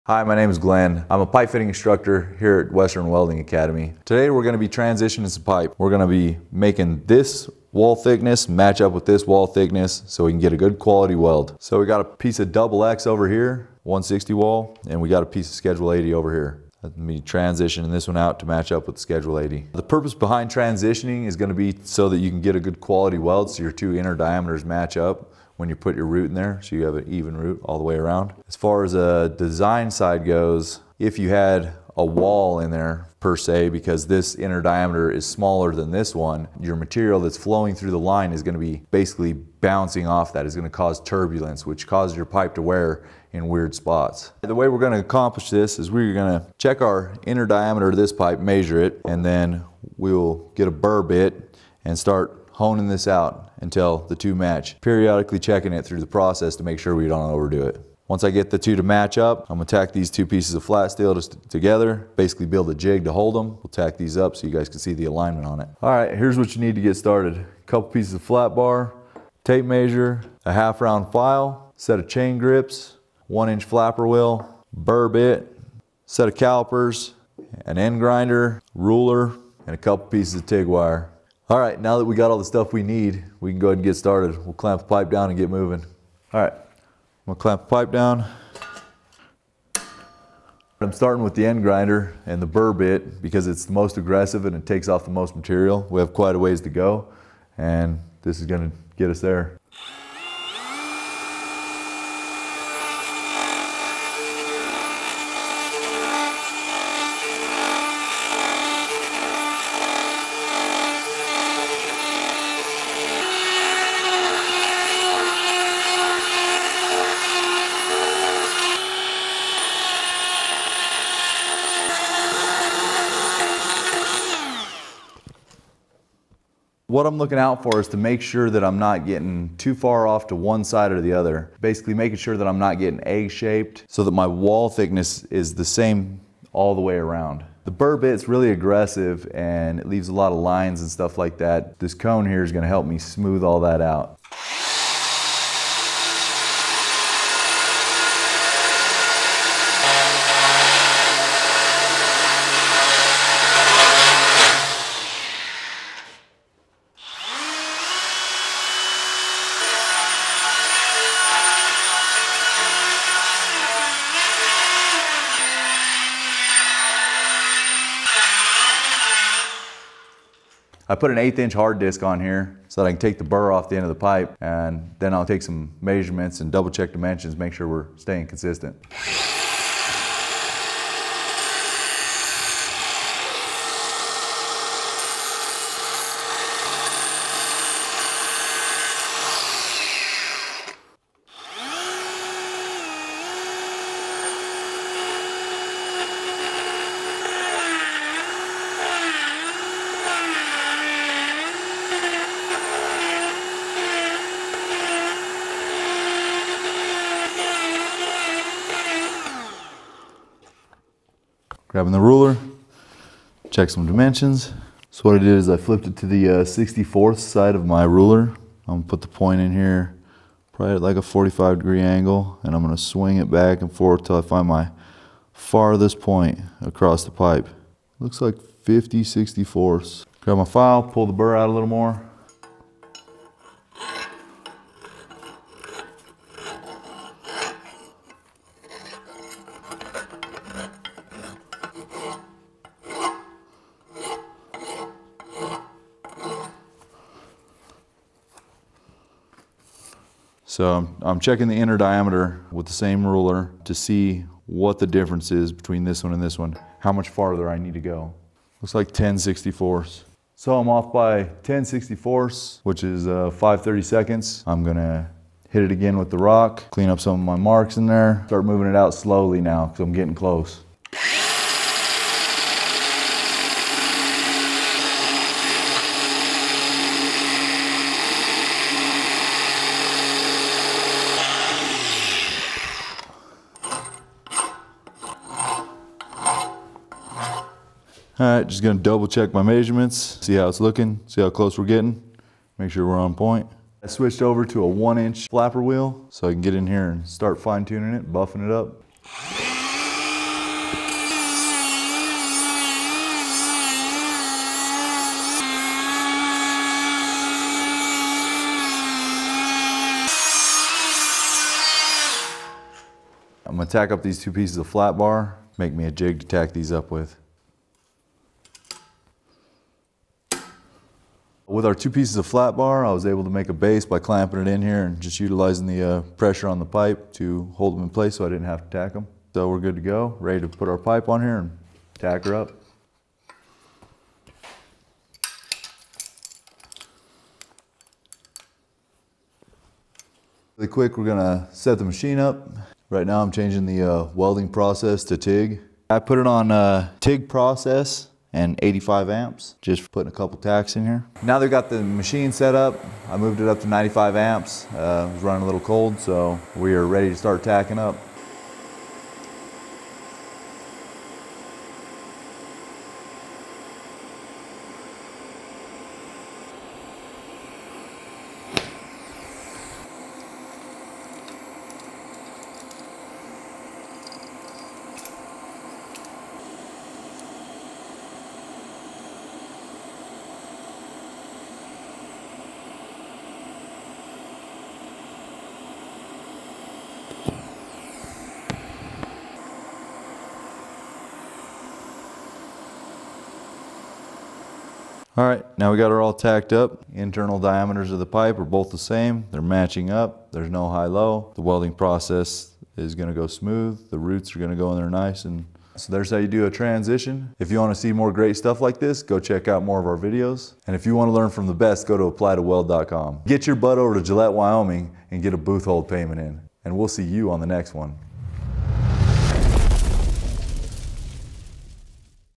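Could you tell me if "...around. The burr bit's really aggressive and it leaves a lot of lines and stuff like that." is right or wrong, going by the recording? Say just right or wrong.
right.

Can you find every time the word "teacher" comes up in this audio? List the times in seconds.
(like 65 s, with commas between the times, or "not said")
not said.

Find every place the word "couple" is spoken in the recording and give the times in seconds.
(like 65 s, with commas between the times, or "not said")
67 s, 79 s, 350 s.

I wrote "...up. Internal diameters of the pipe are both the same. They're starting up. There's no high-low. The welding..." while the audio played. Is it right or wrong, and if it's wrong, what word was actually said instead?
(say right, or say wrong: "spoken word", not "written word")
wrong: "matching", not "starting".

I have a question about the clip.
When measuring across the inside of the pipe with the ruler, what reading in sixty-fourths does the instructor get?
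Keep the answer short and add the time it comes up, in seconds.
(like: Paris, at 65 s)
50/64, at 228 s.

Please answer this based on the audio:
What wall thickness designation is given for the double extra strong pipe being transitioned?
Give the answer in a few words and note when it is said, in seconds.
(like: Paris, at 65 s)
160 wall, at 13 s.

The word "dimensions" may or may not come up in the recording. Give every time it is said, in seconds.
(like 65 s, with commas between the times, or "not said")
176 s, 213 s.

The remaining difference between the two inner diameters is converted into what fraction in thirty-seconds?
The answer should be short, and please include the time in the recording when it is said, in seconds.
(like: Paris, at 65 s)
5/32, at 263 s.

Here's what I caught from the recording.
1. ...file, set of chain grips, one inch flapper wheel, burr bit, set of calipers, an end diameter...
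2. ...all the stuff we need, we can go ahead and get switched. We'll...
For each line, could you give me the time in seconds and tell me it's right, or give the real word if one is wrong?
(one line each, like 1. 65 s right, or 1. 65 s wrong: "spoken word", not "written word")
1. 71 s wrong: "grinder", not "diameter"
2. 82 s wrong: "started", not "switched".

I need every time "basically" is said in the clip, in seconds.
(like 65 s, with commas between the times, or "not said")
38 s, 62 s, 131 s.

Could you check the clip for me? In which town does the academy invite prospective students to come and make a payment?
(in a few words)
Gillette, Wyoming.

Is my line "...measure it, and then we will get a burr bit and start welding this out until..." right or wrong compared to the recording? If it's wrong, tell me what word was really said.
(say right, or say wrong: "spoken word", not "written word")
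wrong: "honing", not "welding".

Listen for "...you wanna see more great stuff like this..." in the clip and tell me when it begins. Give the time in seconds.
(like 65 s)
407 s.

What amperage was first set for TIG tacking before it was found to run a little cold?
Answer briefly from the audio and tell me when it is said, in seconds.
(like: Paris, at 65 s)
85 amps, at 348 s.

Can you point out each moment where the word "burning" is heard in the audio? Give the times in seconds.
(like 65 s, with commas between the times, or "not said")
not said.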